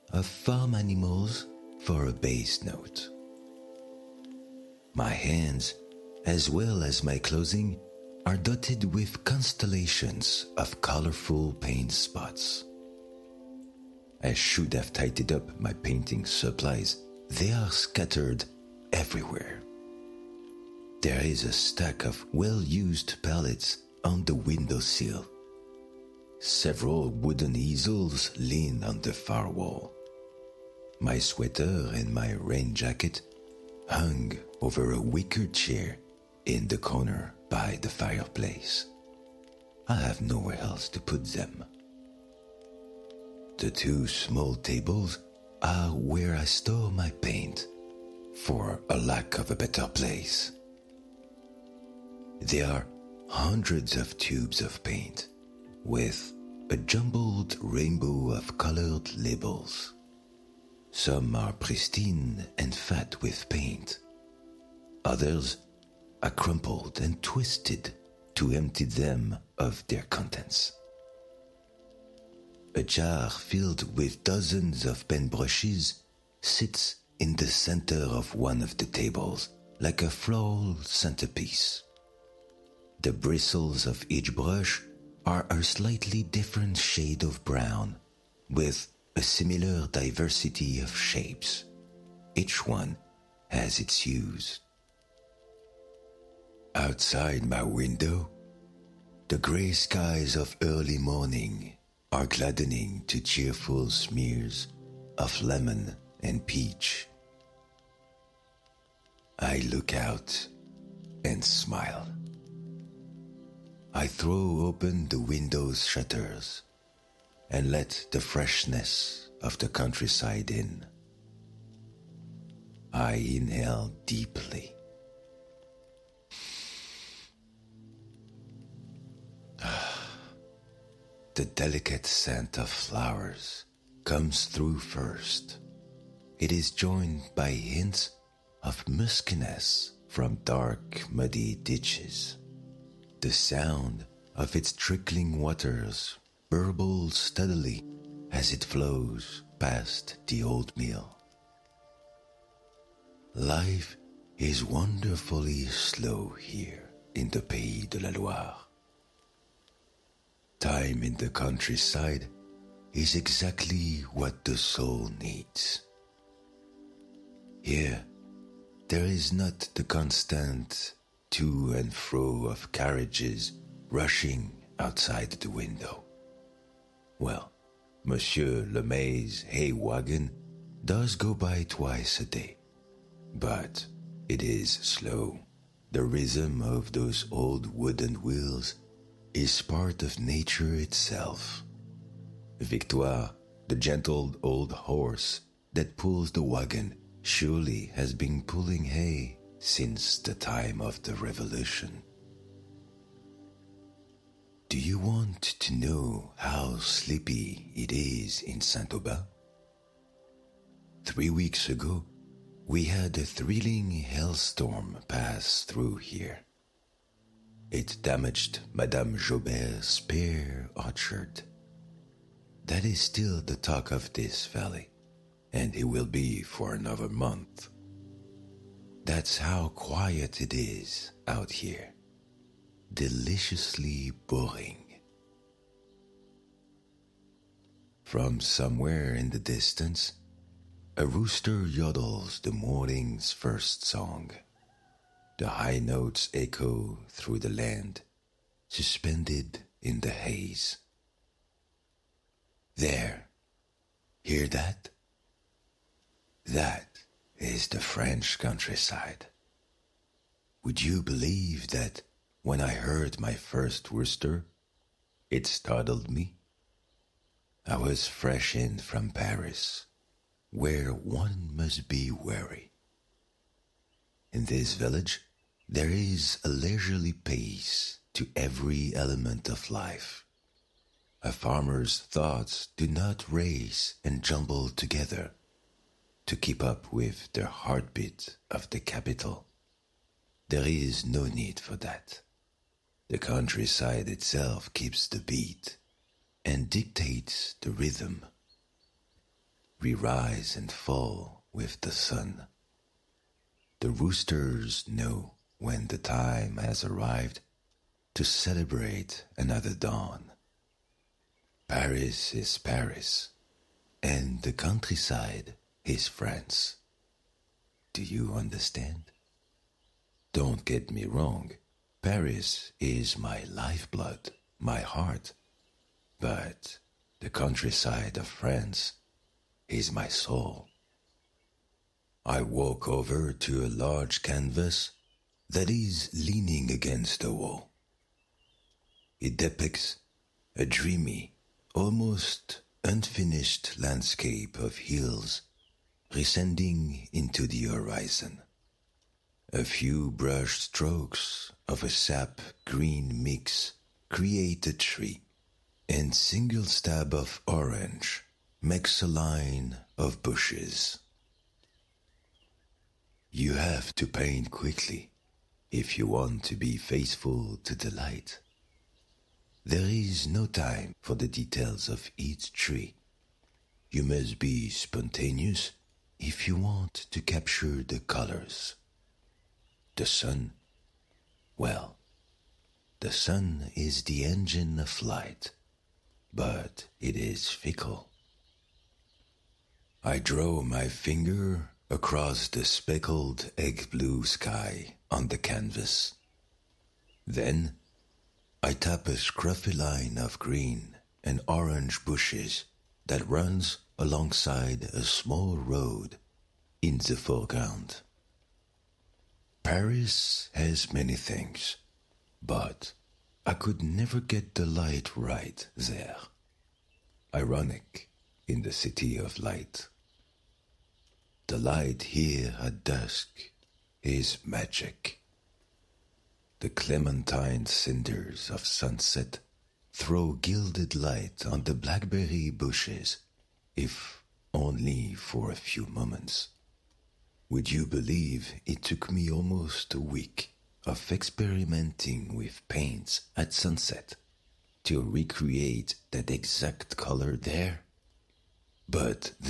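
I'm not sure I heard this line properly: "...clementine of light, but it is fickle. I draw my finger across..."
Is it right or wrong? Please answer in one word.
wrong.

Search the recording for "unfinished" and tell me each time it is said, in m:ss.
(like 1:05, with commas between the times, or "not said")
5:42.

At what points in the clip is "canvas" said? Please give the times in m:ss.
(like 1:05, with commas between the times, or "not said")
5:34, 6:35.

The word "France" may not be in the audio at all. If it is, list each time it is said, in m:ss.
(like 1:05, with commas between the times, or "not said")
5:16, 5:28.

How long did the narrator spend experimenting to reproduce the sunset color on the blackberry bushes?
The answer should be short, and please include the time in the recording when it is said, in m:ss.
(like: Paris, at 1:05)
Almost a week, at 7:19.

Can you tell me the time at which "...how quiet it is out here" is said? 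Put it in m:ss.
3:49.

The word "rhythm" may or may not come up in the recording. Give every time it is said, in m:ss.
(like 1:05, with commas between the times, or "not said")
3:06, 4:57.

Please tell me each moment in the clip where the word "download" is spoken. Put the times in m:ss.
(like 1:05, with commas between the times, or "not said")
not said.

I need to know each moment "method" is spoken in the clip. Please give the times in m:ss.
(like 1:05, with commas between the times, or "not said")
not said.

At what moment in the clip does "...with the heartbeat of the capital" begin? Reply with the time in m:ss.
4:46.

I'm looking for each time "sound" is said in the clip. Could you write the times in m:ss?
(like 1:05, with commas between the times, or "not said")
2:23.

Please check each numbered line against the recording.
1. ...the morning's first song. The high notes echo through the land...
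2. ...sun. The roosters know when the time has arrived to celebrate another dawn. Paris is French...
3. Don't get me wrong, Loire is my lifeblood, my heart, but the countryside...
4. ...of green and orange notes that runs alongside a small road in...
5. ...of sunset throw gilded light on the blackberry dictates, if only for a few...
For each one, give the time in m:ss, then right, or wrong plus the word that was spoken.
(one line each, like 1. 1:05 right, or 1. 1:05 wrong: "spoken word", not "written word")
1. 4:02 right
2. 5:01 wrong: "Paris", not "French"
3. 5:20 wrong: "Paris", not "Loire"
4. 6:40 wrong: "bushes", not "notes"
5. 7:08 wrong: "bushes", not "dictates".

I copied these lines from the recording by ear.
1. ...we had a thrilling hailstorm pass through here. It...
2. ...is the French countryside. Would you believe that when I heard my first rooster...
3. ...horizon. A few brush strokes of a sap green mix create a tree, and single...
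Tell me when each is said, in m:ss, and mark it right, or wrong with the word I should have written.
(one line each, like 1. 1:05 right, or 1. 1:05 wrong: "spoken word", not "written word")
1. 3:32 right
2. 4:17 right
3. 5:47 right.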